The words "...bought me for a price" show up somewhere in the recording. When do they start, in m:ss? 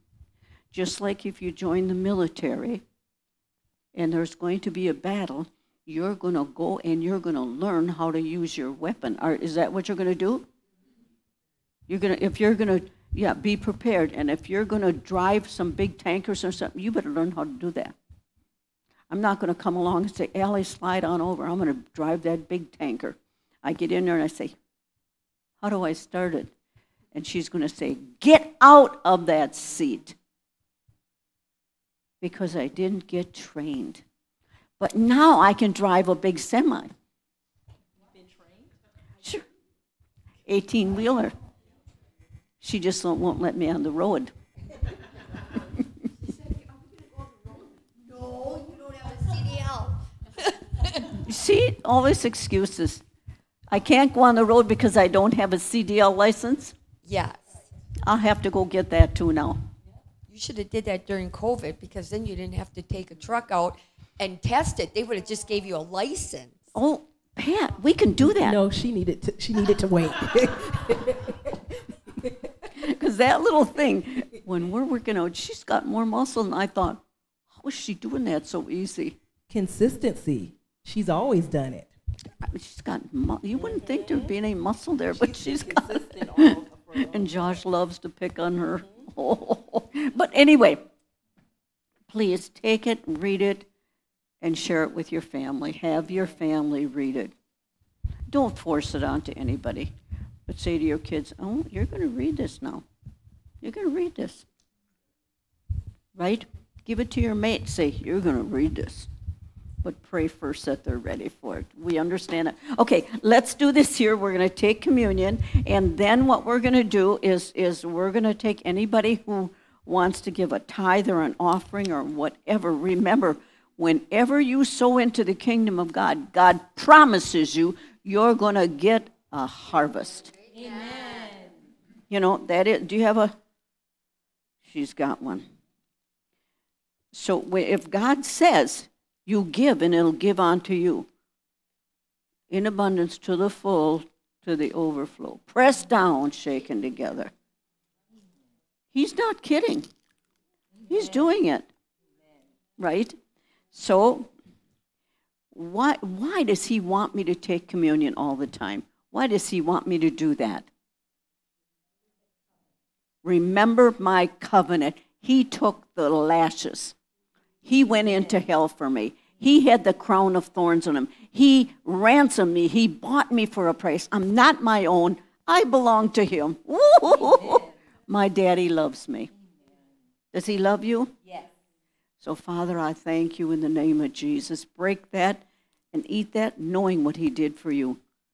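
2:52.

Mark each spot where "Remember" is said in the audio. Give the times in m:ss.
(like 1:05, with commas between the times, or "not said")
2:02, 2:43.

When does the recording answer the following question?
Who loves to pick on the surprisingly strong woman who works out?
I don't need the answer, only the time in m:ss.
1:27.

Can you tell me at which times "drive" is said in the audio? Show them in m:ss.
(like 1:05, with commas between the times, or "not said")
0:14, 0:21, 0:35.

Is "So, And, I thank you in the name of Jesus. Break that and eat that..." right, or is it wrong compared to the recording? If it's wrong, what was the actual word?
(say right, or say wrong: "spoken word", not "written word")
wrong: "Father", not "And".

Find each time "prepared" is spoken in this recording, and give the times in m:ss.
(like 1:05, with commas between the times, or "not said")
0:13.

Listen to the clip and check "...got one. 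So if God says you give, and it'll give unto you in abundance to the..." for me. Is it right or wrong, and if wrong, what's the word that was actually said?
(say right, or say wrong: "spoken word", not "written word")
right.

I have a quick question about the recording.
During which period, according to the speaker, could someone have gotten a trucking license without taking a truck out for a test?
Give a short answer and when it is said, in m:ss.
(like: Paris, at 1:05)
COVID, at 1:01.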